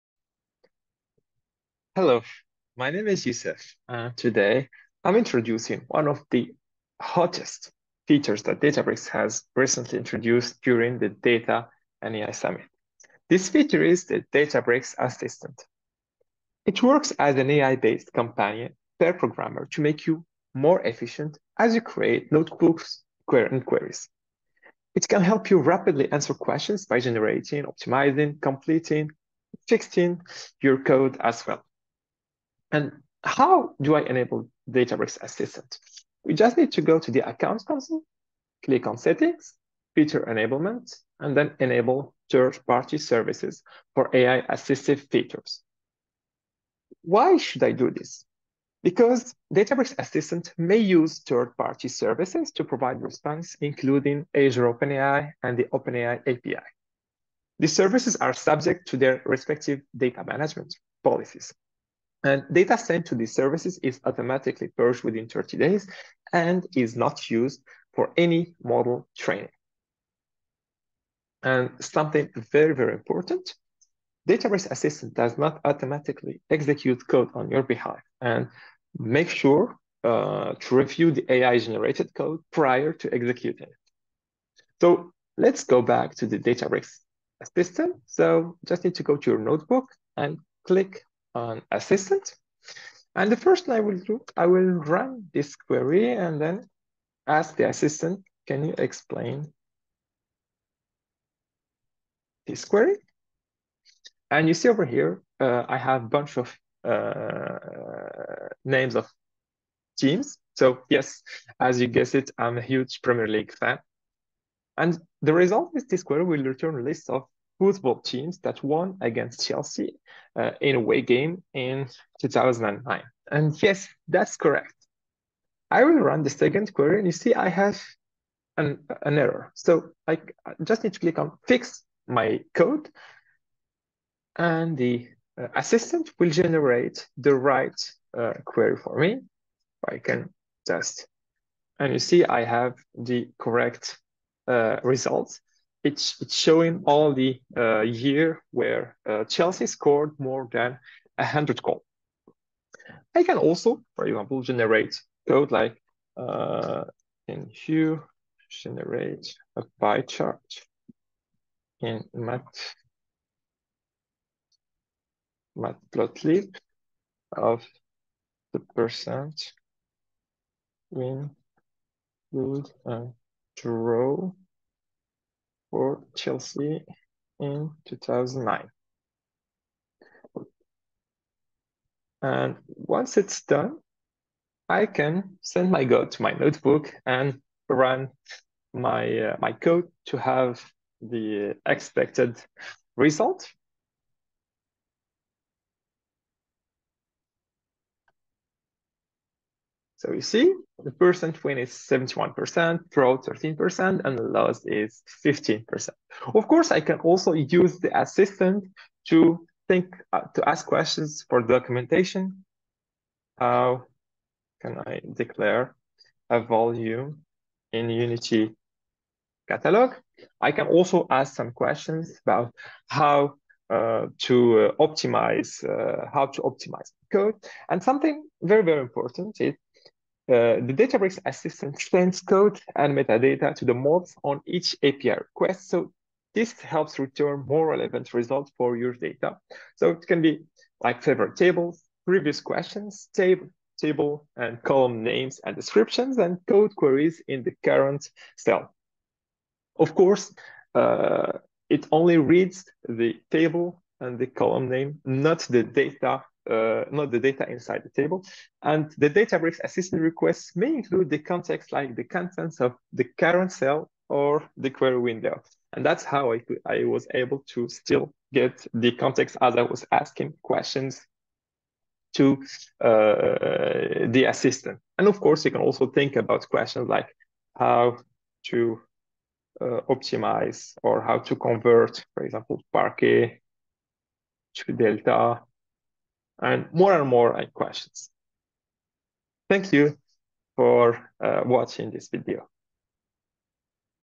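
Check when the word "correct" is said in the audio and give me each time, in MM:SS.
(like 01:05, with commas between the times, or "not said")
02:04, 02:23.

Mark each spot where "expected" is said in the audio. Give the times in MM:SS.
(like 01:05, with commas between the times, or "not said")
03:11.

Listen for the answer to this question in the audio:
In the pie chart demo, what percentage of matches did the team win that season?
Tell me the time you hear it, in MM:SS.
03:21.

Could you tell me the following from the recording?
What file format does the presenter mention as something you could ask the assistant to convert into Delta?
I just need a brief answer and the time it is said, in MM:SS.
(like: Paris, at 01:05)
Parquet, at 04:42.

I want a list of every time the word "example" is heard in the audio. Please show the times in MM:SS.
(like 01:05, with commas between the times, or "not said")
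02:34, 04:42.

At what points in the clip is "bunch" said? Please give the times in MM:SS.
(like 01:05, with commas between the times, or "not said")
01:46.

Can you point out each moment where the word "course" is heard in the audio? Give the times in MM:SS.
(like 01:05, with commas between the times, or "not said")
03:26, 04:09, 04:35.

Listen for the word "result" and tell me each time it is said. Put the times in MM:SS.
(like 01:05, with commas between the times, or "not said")
01:55, 02:24, 03:12, 03:58.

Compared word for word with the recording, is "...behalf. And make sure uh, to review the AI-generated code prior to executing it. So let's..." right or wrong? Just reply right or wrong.
right.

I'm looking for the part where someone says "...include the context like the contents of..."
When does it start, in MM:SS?
04:20.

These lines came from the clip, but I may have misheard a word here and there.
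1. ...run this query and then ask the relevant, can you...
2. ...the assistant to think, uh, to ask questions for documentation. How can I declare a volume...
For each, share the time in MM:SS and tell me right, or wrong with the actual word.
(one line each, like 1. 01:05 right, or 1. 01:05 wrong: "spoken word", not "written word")
1. 01:34 wrong: "assistant", not "relevant"
2. 03:27 right.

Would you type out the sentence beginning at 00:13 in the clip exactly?
This feature is the Databricks Assistant.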